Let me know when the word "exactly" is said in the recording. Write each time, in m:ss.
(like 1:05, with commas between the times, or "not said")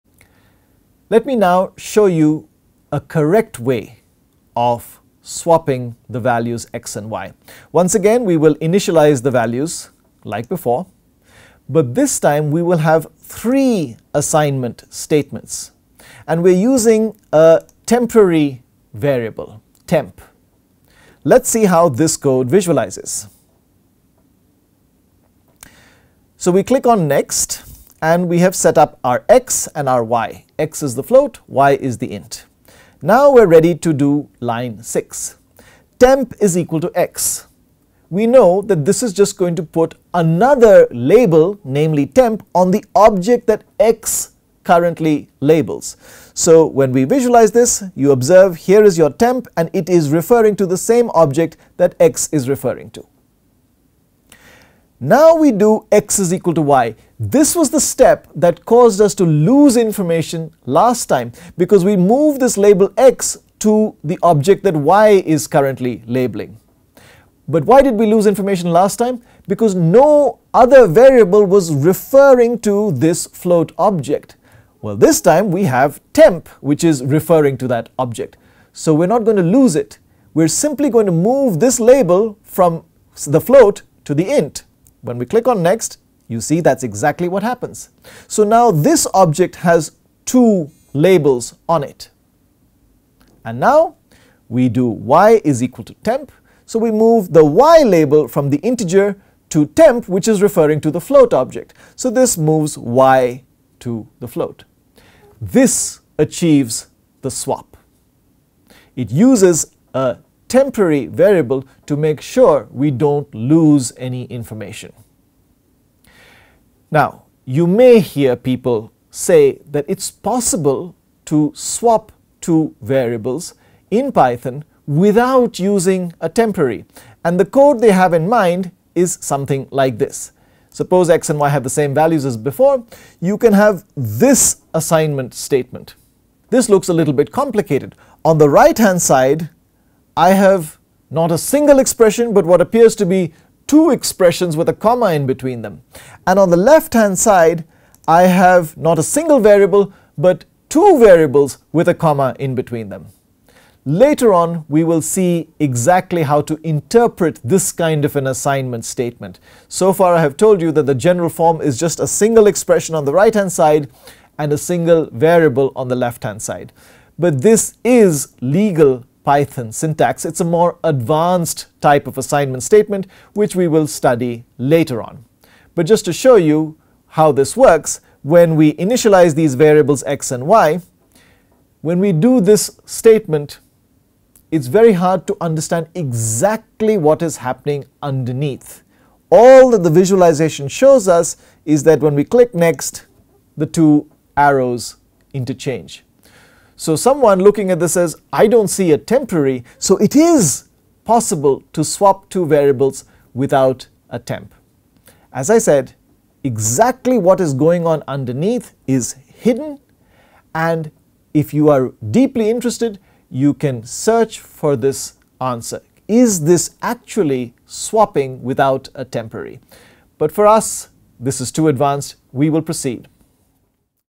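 1:26, 2:35, 3:05, 3:26.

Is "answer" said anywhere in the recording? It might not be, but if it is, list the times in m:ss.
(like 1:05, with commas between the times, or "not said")
3:35.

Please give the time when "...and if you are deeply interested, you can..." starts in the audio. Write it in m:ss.
3:30.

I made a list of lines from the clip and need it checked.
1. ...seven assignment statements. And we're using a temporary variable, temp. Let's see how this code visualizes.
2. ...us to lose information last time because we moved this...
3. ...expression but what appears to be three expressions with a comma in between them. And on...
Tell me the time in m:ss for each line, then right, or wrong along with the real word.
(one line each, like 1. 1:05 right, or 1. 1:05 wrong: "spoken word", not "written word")
1. 0:13 wrong: "three", not "seven"
2. 0:58 right
3. 2:21 wrong: "two", not "three".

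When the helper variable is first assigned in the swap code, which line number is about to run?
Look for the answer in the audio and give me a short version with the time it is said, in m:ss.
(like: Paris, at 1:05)
6, at 0:34.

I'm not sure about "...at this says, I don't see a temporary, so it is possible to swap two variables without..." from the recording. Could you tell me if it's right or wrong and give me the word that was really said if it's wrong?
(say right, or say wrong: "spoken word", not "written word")
right.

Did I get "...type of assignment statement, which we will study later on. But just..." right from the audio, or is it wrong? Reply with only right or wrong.
right.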